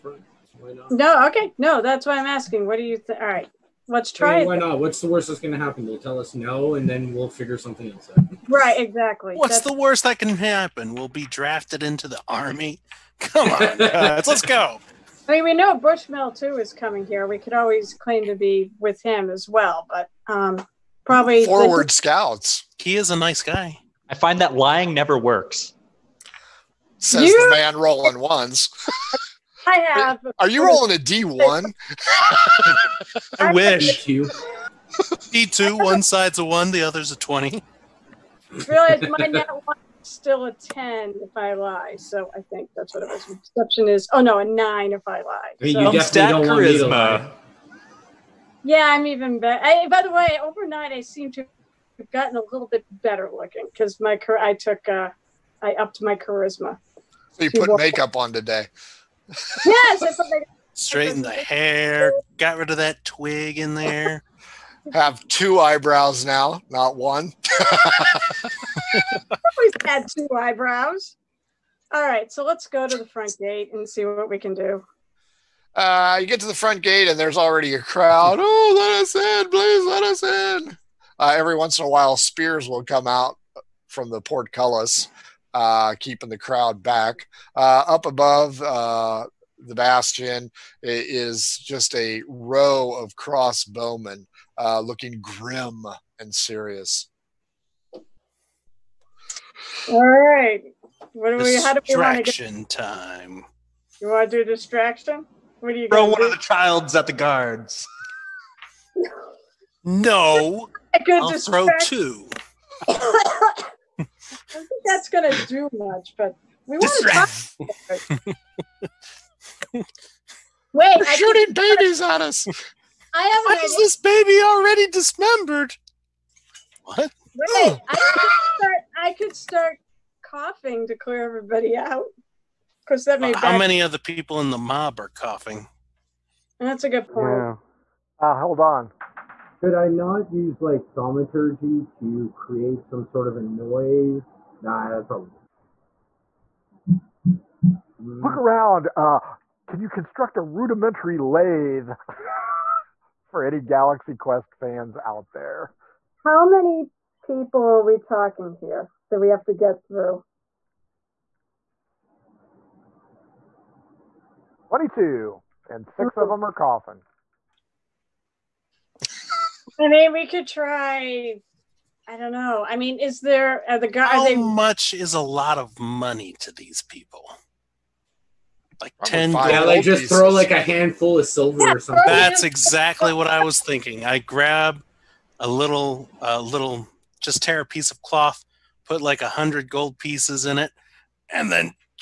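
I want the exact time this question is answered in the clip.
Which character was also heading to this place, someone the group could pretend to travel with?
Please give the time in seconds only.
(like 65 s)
15 s.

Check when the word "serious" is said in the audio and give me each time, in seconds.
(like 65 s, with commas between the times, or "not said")
96 s.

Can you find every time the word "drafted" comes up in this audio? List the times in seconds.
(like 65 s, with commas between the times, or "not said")
11 s.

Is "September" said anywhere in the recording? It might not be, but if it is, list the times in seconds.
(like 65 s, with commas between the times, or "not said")
not said.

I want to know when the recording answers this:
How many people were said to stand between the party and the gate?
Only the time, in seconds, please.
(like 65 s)
164 s.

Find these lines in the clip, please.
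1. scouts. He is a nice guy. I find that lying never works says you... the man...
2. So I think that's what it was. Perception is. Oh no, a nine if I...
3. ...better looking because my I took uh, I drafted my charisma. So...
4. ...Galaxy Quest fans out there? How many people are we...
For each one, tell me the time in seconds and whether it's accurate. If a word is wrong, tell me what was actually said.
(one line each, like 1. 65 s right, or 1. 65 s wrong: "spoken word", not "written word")
1. 21 s right
2. 41 s right
3. 53 s wrong: "upped", not "drafted"
4. 153 s right.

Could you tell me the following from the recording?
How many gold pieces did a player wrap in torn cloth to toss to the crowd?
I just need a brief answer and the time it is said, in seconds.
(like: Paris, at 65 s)
100, at 189 s.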